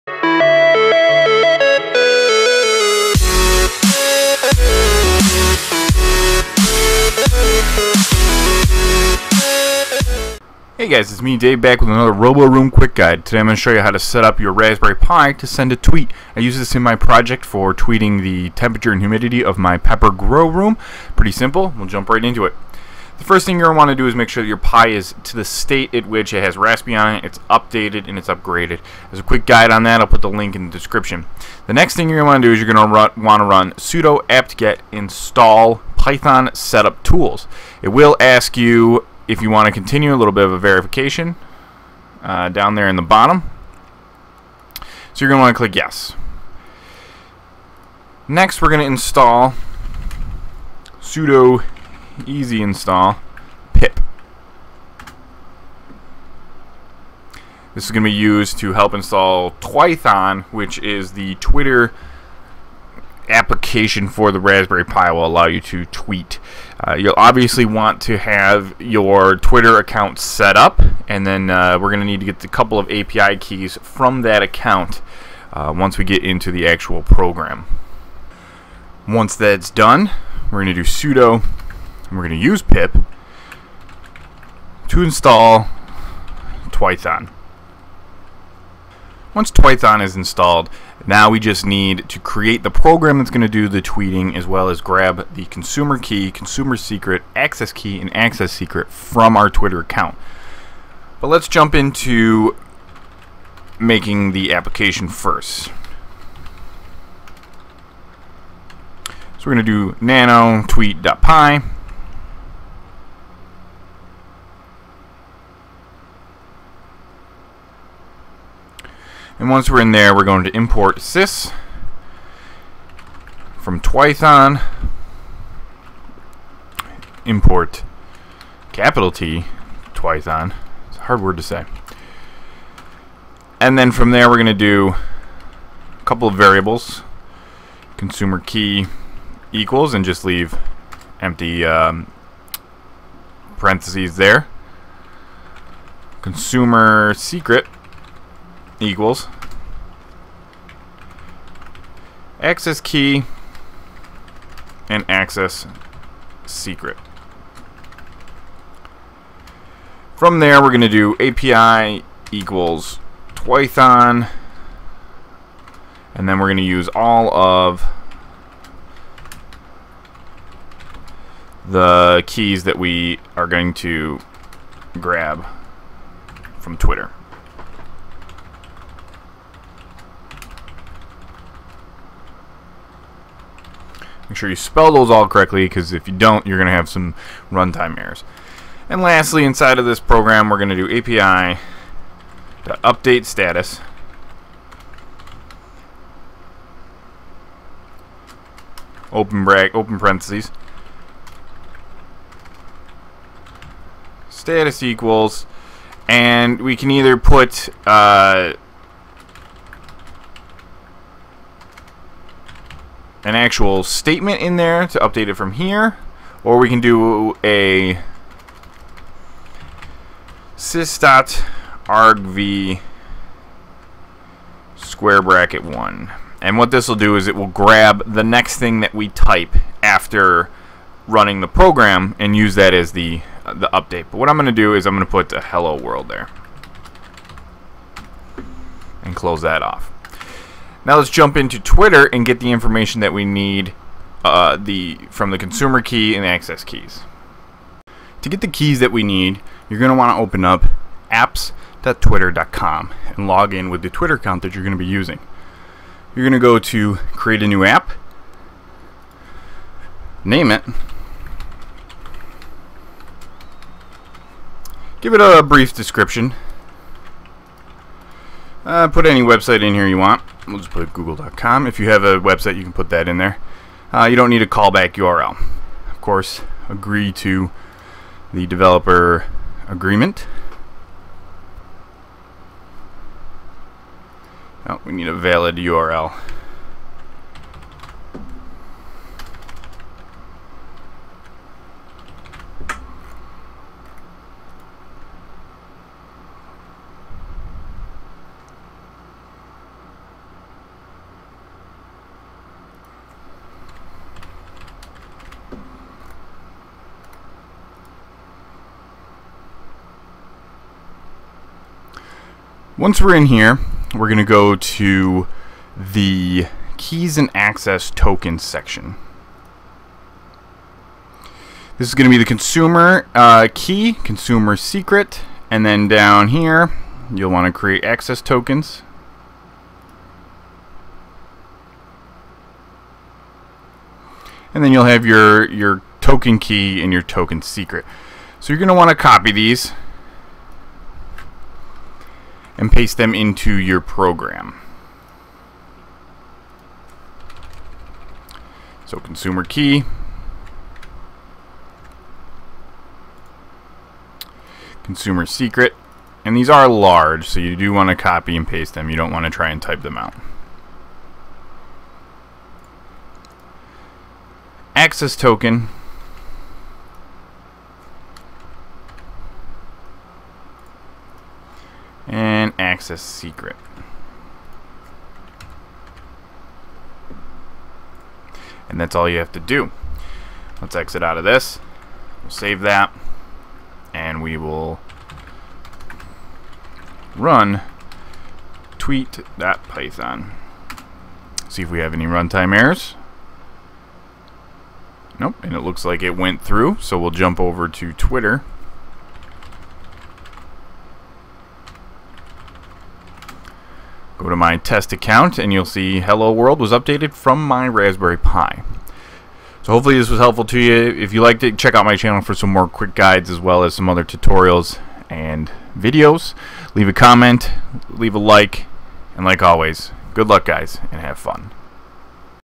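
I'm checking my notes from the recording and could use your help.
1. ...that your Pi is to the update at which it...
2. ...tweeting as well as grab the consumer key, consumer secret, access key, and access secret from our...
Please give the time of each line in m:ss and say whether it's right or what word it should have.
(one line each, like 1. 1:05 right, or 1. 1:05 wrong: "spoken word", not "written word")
1. 0:24 wrong: "state", not "update"
2. 1:33 right.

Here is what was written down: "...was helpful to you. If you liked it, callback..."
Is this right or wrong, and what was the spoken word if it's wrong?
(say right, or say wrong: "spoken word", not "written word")
wrong: "check", not "callback".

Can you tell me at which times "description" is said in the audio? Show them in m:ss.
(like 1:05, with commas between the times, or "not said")
0:30, 4:25.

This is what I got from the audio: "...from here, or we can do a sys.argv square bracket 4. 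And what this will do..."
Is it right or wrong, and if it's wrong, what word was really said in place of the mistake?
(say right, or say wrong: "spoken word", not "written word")
wrong: "1", not "4".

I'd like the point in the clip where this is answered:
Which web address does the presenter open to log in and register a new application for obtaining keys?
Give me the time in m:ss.
4:11.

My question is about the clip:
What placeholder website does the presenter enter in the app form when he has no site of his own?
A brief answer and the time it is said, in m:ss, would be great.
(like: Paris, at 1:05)
google.com, at 4:30.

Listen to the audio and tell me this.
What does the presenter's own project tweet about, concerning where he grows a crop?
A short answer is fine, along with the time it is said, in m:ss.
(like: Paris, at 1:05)
pepper grow room, at 0:19.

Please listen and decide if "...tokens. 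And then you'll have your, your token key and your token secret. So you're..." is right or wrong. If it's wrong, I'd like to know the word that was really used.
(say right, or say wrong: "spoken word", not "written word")
right.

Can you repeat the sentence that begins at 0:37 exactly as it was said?
It will ask you if you want to continue, a little bit of a verification uh, down there in the bottom.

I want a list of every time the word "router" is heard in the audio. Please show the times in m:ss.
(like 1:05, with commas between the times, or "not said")
not said.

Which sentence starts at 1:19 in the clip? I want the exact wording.
Once that's done, we're going to do sudo, and we're going to use pip to install Twython.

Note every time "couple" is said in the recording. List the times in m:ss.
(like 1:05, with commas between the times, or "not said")
1:12, 2:16.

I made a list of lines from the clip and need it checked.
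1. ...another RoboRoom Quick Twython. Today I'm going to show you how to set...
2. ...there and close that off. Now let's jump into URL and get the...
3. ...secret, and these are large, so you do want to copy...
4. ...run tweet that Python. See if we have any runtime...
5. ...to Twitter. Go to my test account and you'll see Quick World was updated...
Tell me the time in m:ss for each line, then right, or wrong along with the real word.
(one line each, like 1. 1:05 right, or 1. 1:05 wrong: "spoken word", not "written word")
1. 0:11 wrong: "Guide", not "Twython"
2. 3:56 wrong: "Twitter", not "URL"
3. 5:55 right
4. 6:27 right
5. 6:37 wrong: "Hello", not "Quick".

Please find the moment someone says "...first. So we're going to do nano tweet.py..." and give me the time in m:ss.
1:45.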